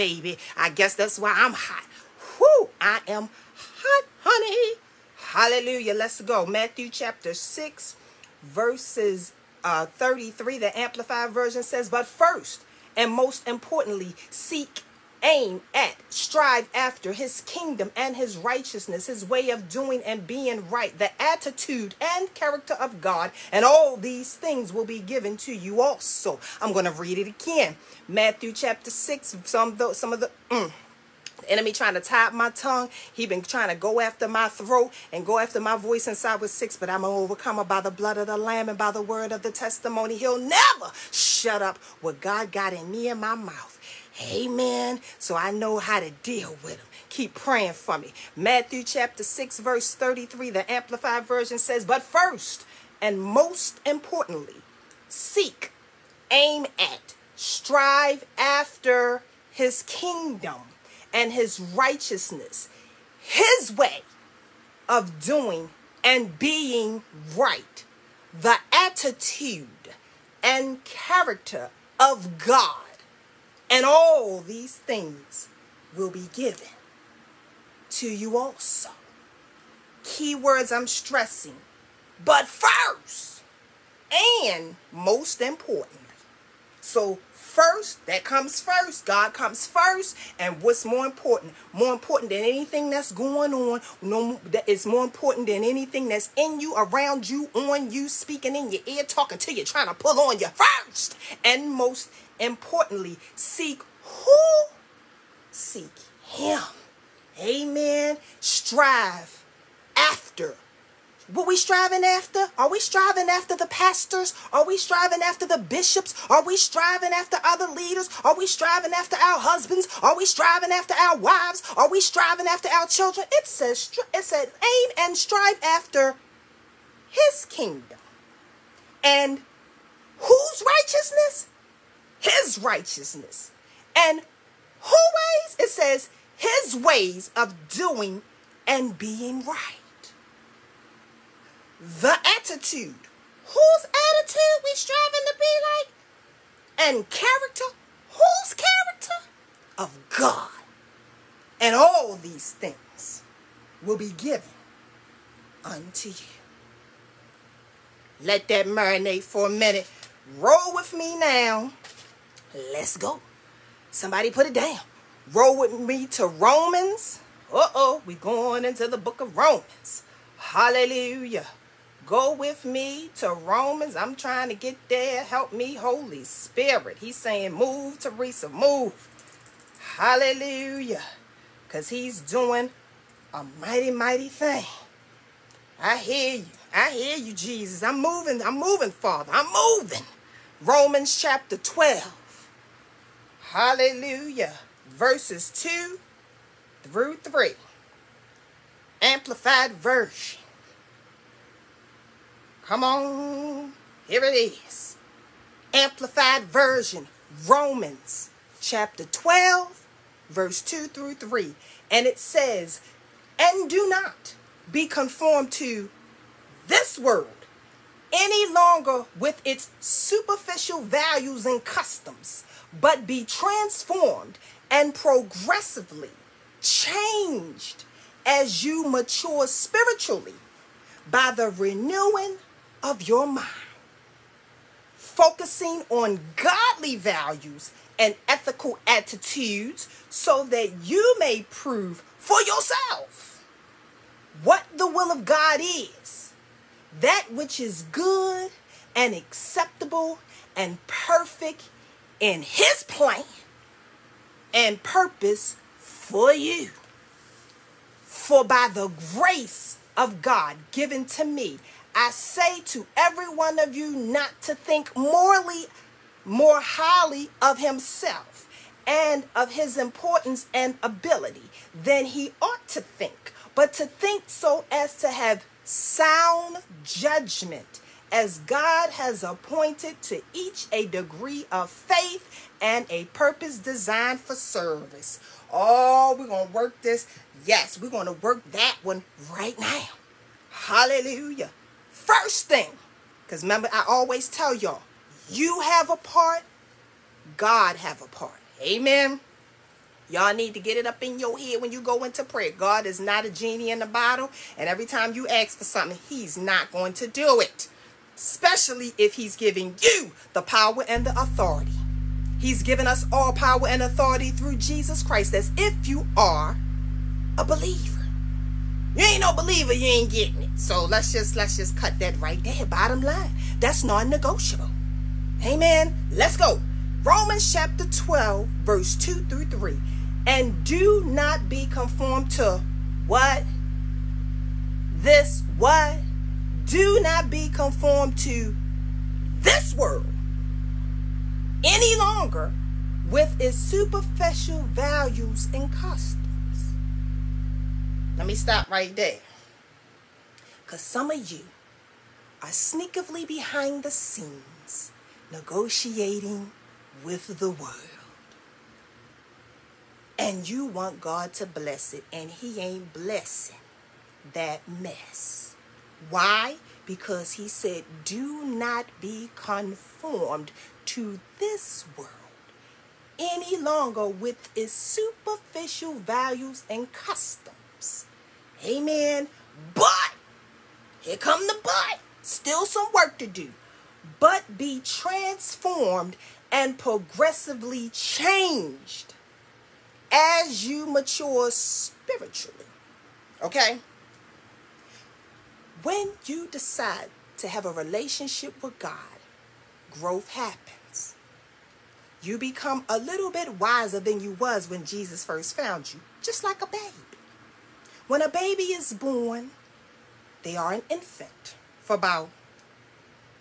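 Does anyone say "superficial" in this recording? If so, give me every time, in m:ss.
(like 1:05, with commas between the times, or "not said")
3:39, 5:43, 6:14.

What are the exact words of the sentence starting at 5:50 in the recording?
Because some of you are sneakily behind the scenes negotiating with the world.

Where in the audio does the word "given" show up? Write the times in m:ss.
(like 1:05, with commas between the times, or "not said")
0:24, 1:16, 2:34, 4:20, 5:12.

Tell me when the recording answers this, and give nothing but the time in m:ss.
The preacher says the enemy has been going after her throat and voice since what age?
0:36.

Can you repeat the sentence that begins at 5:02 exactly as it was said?
God is not a genie in a bottle, and every time you ask for something, he's not going to do it.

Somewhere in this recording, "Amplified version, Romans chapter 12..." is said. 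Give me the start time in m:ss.
3:25.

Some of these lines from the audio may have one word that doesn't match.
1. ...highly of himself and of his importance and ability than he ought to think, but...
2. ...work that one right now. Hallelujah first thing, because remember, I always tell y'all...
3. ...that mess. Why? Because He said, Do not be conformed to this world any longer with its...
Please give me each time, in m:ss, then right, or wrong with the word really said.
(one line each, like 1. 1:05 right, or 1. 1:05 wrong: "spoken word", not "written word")
1. 4:26 right
2. 4:48 right
3. 6:04 right.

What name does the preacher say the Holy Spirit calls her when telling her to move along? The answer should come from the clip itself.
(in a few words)
Taresa.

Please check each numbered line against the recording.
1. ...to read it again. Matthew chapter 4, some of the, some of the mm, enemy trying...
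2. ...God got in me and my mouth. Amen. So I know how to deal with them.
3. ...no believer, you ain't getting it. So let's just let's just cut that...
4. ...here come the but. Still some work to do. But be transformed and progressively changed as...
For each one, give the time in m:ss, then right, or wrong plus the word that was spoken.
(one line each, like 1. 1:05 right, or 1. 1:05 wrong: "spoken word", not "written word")
1. 0:26 wrong: "6", not "4"
2. 0:42 right
3. 5:19 right
4. 6:21 right.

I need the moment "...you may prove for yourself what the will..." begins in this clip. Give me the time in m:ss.
4:00.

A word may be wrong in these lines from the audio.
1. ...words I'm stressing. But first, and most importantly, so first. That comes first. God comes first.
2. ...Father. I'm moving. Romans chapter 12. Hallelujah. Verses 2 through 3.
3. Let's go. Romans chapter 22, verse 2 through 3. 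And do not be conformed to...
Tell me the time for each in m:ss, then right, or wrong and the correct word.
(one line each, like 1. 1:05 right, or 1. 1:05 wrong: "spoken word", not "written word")
1. 1:20 right
2. 3:08 right
3. 5:26 wrong: "12", not "22".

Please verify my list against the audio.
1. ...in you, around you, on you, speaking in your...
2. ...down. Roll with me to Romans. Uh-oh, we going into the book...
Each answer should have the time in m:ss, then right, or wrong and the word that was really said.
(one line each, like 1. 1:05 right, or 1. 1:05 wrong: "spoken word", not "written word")
1. 1:36 right
2. 2:44 right.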